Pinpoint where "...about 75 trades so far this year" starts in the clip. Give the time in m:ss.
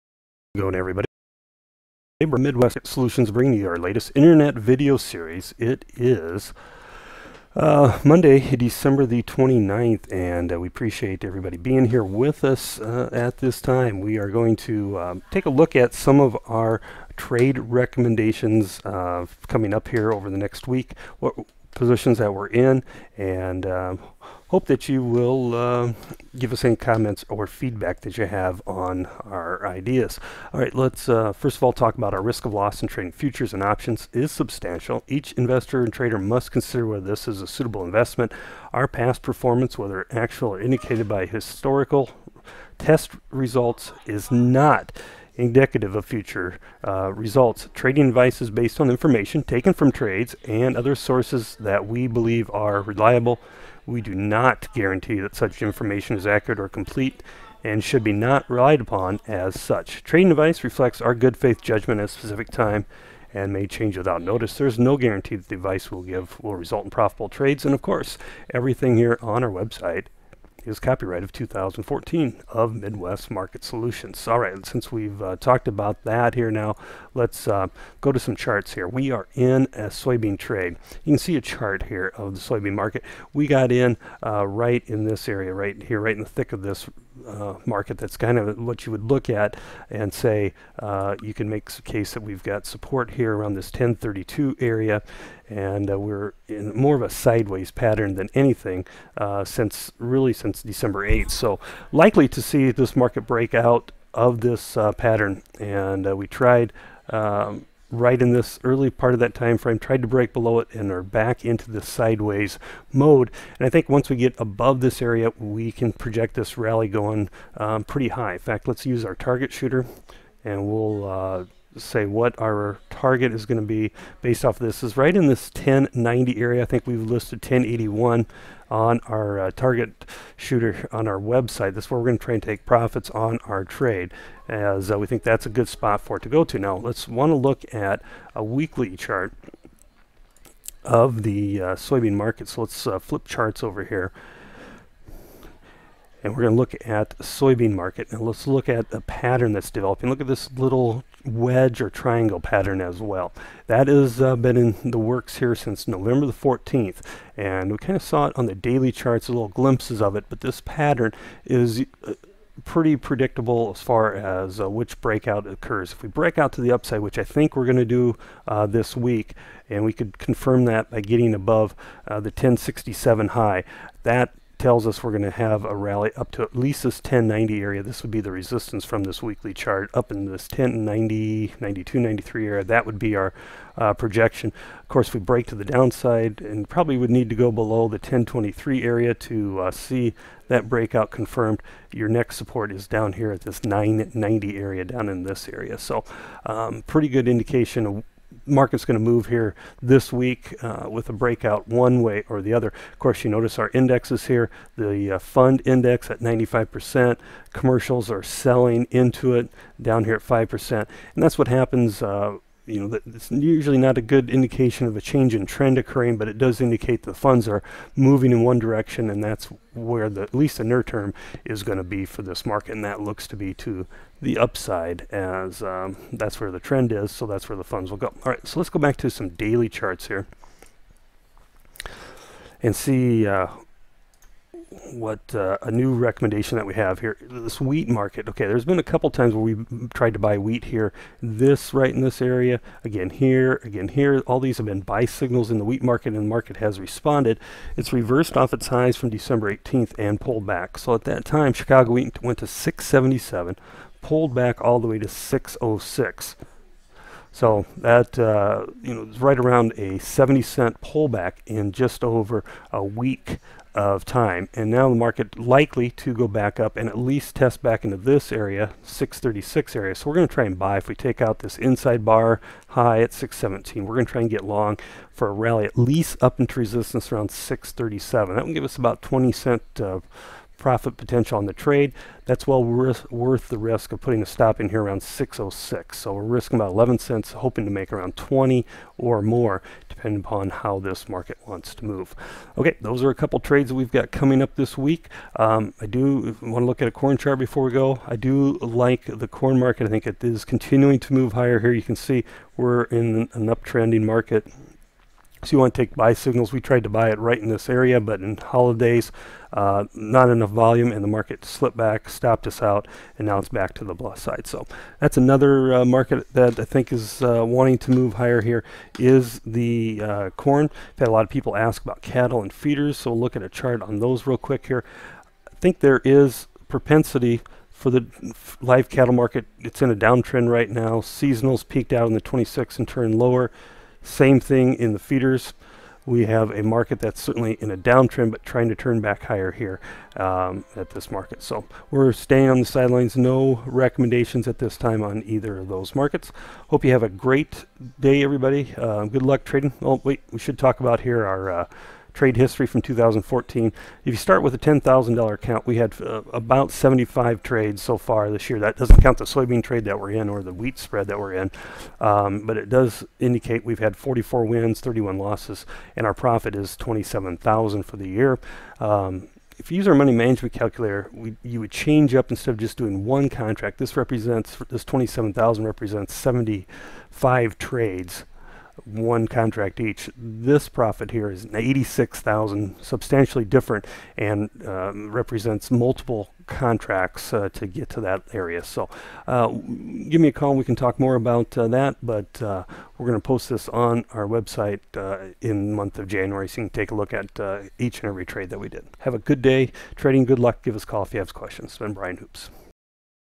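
5:56.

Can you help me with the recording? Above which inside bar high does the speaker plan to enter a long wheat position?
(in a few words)
617.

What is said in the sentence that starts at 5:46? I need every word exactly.
Hope you have a great day, everybody.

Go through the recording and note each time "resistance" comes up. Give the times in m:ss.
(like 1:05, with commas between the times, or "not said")
2:58, 4:36.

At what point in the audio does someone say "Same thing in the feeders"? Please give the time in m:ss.
5:34.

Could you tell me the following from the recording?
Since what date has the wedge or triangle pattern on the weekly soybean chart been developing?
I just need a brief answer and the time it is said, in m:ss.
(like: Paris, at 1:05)
November 14, at 2:35.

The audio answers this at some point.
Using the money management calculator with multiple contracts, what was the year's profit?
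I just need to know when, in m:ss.
6:21.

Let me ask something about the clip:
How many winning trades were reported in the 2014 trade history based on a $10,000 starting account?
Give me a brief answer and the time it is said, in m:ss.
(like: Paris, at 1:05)
44, at 6:03.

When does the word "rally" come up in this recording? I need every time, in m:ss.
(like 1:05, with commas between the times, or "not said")
1:56, 2:55, 4:35.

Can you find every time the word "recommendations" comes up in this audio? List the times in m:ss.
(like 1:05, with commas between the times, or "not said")
0:17, 3:55, 5:43.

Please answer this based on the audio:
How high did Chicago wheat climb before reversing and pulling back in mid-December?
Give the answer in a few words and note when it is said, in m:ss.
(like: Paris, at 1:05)
677, at 4:12.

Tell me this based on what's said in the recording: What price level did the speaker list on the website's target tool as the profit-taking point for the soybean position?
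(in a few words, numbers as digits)
1081.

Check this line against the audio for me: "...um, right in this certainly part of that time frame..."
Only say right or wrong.
wrong.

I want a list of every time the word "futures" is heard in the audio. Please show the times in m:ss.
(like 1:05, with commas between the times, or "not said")
0:33, 0:46.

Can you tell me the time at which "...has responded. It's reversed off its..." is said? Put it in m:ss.
4:06.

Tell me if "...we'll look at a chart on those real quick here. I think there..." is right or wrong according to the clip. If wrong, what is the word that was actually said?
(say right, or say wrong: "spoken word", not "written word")
right.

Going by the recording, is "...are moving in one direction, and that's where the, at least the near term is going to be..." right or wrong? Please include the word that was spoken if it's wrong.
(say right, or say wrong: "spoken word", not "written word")
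right.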